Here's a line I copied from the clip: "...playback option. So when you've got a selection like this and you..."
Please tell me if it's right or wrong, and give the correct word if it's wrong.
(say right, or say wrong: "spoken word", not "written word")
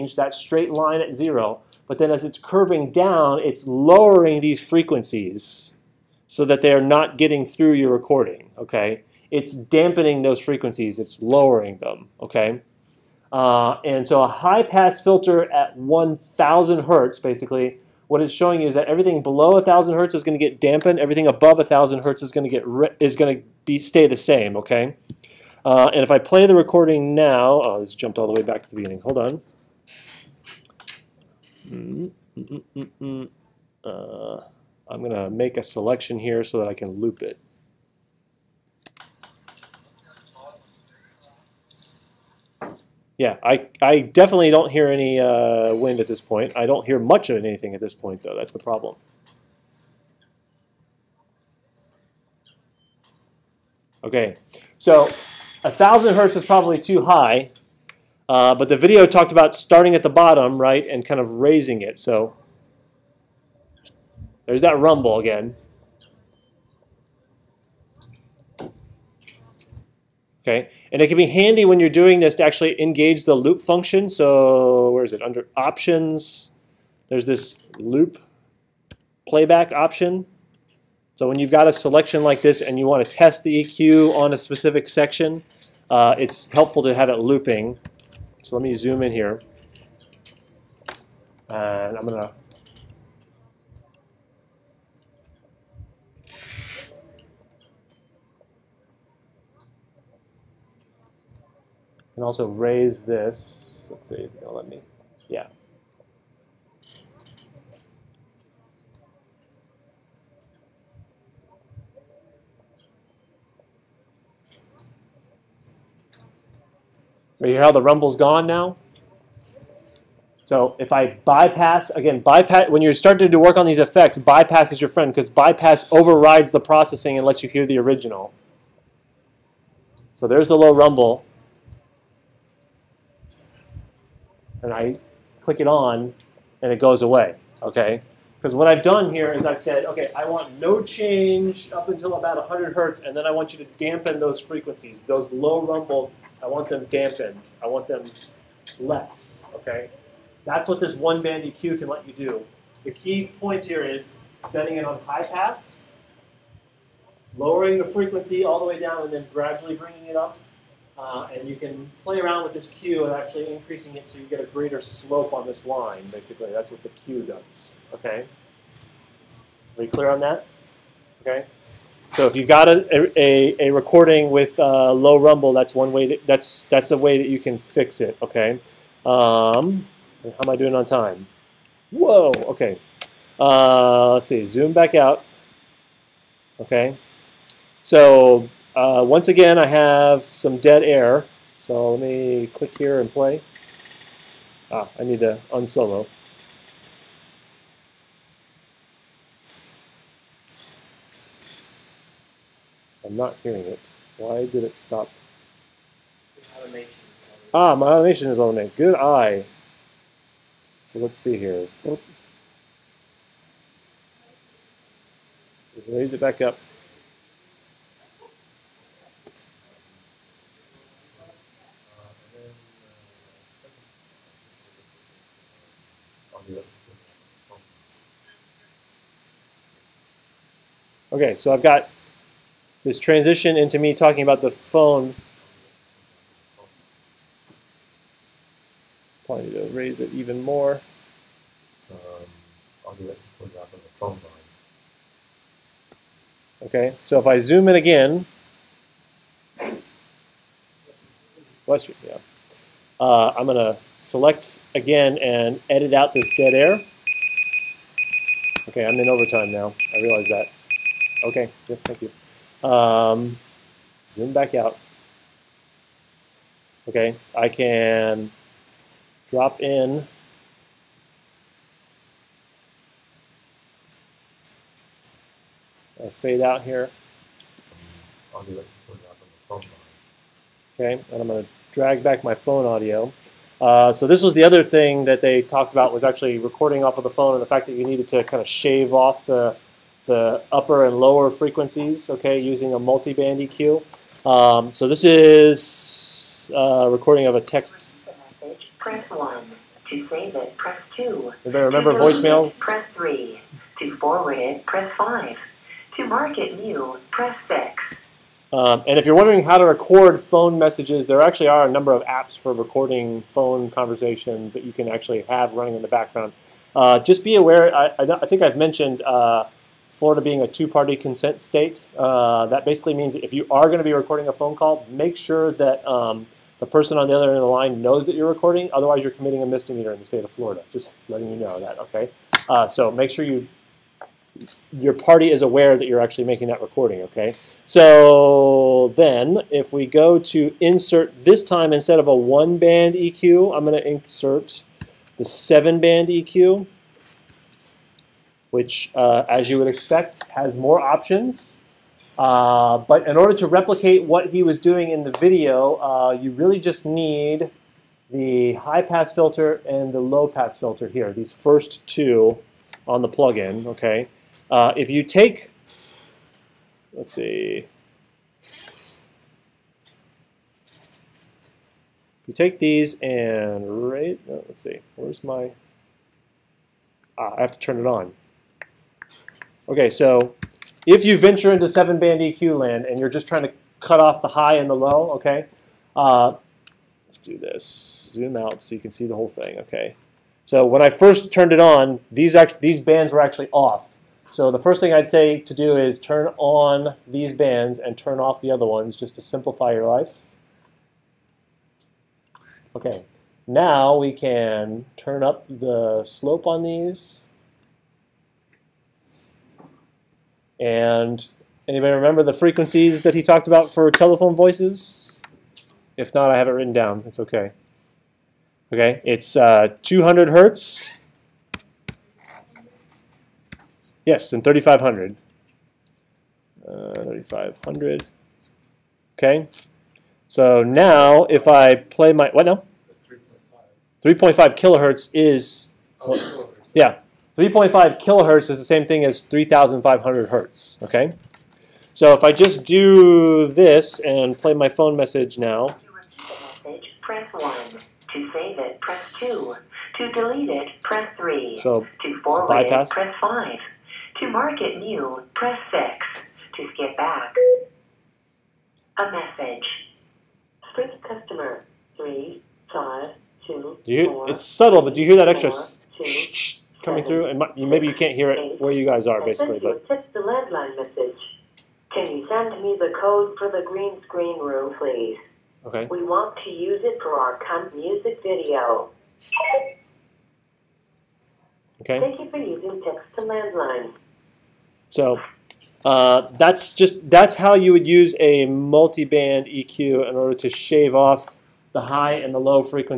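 right.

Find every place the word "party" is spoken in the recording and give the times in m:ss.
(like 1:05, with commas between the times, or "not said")
5:20, 5:34.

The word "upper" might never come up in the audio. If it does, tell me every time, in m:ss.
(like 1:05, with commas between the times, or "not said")
4:50.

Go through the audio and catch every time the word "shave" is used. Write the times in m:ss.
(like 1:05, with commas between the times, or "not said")
4:48, 8:10.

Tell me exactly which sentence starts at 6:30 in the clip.
So when I first turned it on, these, these bands were actually off.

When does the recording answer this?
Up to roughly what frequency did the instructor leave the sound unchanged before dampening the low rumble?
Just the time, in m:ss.
2:22.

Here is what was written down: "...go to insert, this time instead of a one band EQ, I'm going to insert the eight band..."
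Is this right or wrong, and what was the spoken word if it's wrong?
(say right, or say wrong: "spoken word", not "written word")
wrong: "seven", not "eight".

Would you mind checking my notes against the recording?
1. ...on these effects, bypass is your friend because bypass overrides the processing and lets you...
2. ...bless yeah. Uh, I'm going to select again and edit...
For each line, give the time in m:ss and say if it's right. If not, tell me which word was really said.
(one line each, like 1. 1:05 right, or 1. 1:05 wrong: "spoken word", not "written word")
1. 2:03 right
2. 4:11 right.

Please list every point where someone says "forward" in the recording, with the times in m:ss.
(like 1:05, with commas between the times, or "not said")
5:03, 7:32.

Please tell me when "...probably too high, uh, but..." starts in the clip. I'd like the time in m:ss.
0:56.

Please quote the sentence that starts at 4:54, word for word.
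Um, so this is a uh, recording of a text.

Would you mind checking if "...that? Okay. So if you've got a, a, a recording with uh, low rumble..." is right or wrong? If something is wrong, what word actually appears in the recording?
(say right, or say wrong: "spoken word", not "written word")
right.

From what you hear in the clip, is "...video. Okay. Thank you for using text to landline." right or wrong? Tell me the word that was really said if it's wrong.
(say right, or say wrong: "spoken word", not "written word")
right.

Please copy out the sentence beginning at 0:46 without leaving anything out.
I don't hear much of anything at this point, though.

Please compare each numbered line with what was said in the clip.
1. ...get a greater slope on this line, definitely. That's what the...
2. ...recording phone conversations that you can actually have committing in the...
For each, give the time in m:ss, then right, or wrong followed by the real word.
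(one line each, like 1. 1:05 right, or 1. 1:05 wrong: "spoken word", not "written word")
1. 2:44 wrong: "basically", not "definitely"
2. 5:12 wrong: "running", not "committing".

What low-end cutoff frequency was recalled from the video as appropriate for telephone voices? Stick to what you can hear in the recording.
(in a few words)
200 hertz.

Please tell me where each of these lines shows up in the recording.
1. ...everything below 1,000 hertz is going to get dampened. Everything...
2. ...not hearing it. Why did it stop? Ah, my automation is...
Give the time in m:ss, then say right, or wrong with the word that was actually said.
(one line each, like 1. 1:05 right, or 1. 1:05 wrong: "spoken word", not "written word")
1. 0:18 right
2. 3:23 right.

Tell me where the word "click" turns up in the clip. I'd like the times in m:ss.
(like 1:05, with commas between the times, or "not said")
2:15, 3:12.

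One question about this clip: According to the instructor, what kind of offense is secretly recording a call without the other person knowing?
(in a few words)
misdemeanor.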